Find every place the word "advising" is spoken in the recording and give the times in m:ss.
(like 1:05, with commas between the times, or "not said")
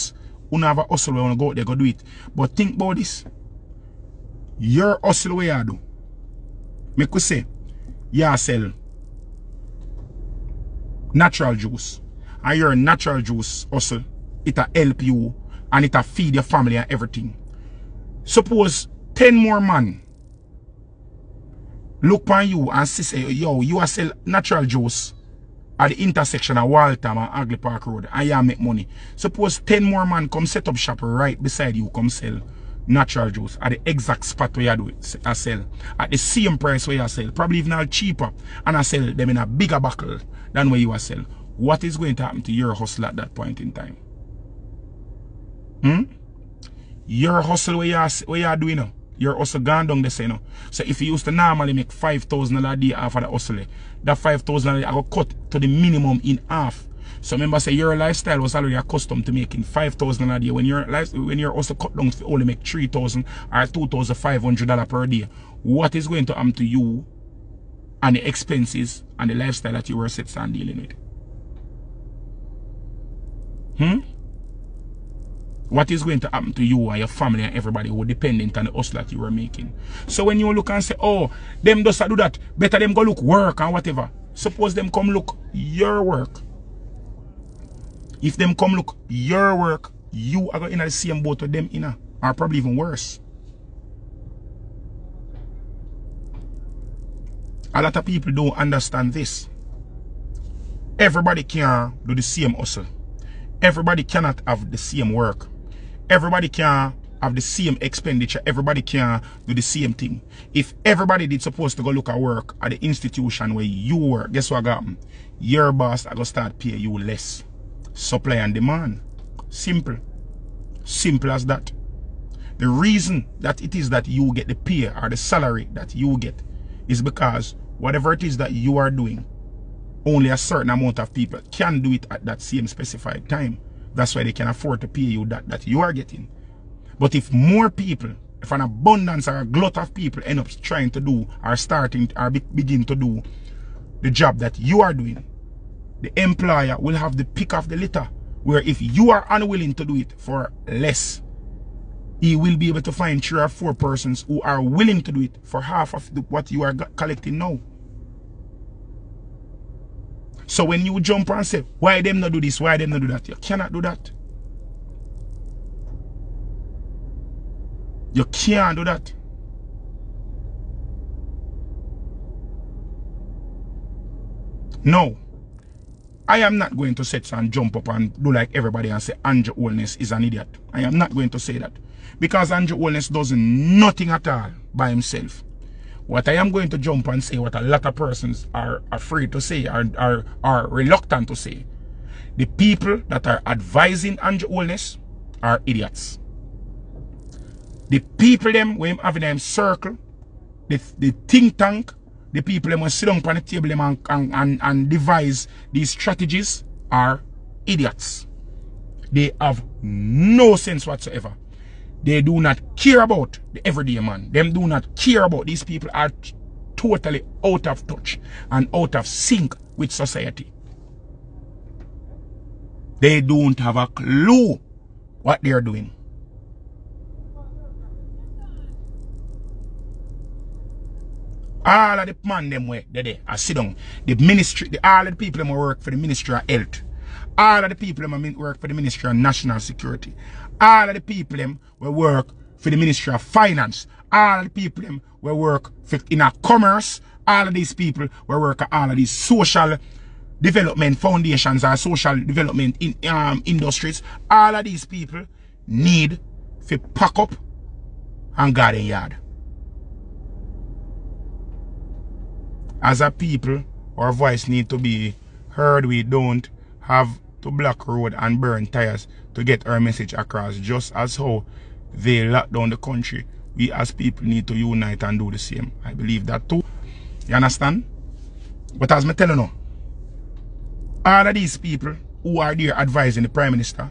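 3:13, 4:42.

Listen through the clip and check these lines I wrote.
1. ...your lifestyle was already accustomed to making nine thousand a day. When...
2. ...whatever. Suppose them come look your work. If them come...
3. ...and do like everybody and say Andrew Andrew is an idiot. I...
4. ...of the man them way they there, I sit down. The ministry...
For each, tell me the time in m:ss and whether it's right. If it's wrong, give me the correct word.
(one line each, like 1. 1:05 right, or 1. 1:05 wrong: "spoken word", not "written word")
1. 0:57 wrong: "five", not "nine"
2. 1:23 right
3. 2:57 wrong: "Holness", not "Andrew"
4. 3:51 right.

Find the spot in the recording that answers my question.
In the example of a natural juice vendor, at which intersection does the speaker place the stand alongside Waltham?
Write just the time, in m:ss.
0:27.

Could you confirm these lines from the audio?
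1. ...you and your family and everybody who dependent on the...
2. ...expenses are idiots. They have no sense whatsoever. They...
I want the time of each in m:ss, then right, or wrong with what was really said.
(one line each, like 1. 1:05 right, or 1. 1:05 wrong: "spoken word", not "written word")
1. 1:16 right
2. 3:25 wrong: "strategies", not "expenses".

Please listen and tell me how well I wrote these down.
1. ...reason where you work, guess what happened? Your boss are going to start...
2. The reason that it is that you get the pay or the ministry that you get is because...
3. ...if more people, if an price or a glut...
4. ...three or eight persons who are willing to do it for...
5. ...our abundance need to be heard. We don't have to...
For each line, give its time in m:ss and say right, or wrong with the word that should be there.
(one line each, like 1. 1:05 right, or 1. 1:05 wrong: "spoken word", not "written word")
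1. 1:52 wrong: "institution", not "reason"
2. 2:02 wrong: "salary", not "ministry"
3. 2:17 wrong: "abundance", not "price"
4. 2:33 wrong: "four", not "eight"
5. 4:23 wrong: "voice", not "abundance".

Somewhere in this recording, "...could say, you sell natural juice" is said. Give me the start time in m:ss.
0:07.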